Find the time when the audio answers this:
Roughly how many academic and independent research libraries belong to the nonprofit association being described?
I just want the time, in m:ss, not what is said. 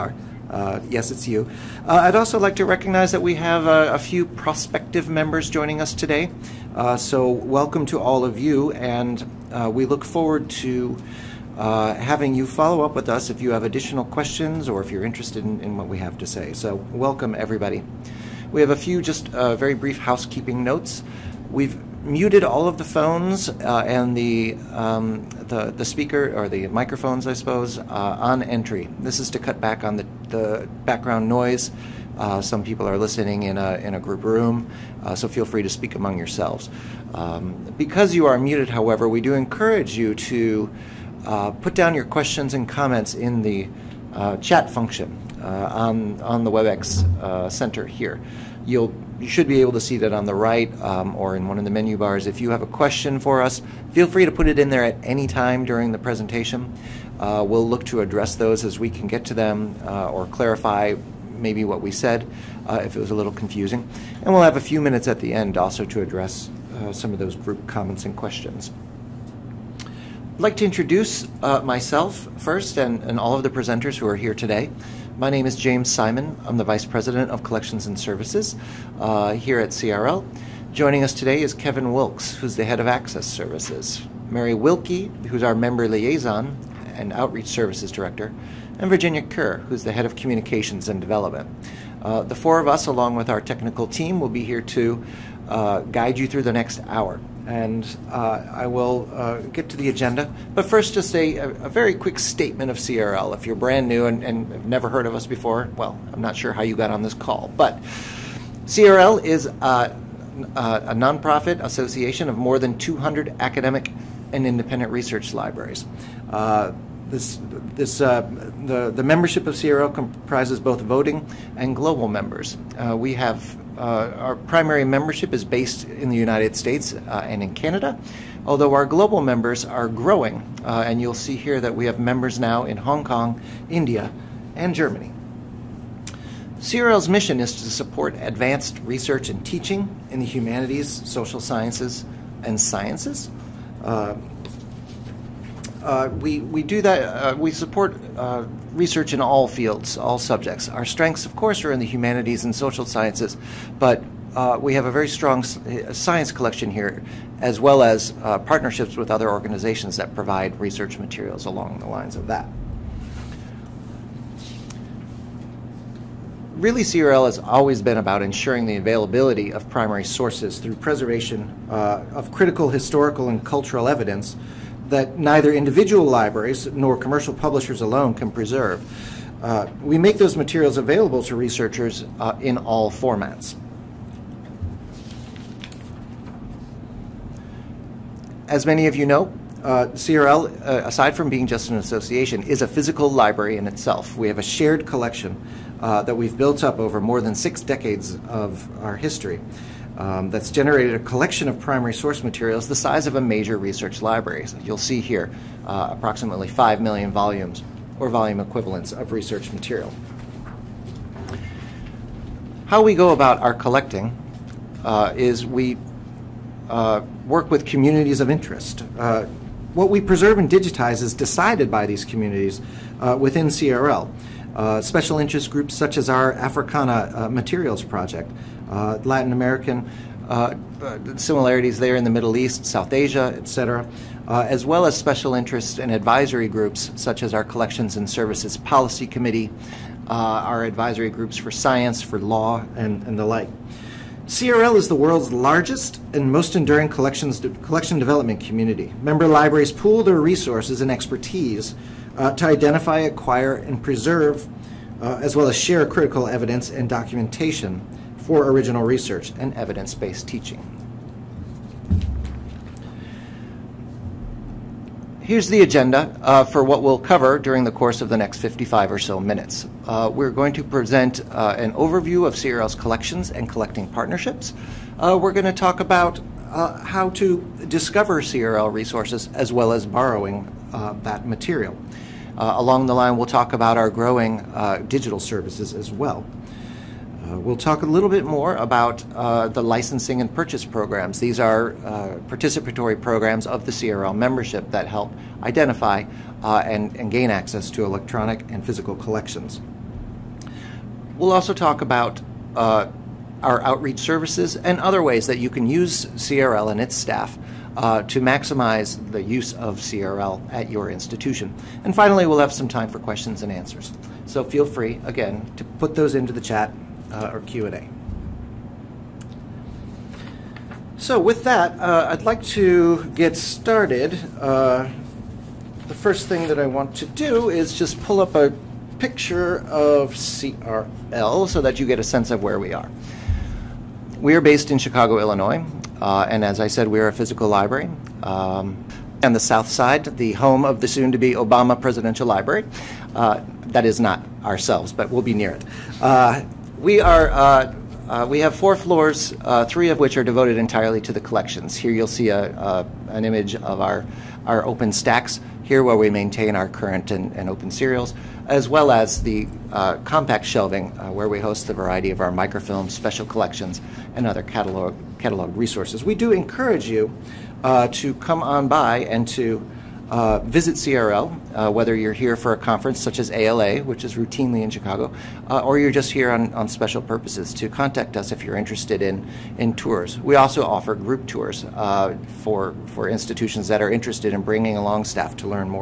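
1:52.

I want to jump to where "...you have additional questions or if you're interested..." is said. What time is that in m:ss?
0:13.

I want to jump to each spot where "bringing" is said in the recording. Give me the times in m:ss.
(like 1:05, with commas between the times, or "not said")
6:24.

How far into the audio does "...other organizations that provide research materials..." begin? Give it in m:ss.
2:39.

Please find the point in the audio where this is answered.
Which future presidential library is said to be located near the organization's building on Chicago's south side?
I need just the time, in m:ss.
5:41.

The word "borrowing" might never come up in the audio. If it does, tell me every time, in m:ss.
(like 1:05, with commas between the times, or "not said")
4:39.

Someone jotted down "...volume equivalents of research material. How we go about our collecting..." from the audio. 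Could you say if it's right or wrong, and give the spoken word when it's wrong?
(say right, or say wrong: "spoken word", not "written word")
right.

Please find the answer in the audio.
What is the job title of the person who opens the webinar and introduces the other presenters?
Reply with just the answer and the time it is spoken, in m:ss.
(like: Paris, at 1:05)
Vice President of Collections and Services, at 1:16.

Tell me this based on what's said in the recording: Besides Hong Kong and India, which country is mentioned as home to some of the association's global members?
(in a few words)
Germany.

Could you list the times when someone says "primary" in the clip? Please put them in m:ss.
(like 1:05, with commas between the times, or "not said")
2:04, 2:49, 3:21.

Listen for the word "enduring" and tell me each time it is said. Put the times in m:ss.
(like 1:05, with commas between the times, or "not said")
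4:06.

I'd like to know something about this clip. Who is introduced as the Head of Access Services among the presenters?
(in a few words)
Kevin Wilkes.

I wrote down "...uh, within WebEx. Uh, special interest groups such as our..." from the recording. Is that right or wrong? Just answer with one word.
wrong.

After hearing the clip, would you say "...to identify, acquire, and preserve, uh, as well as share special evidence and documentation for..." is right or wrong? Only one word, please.
wrong.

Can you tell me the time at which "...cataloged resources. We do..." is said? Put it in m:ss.
6:05.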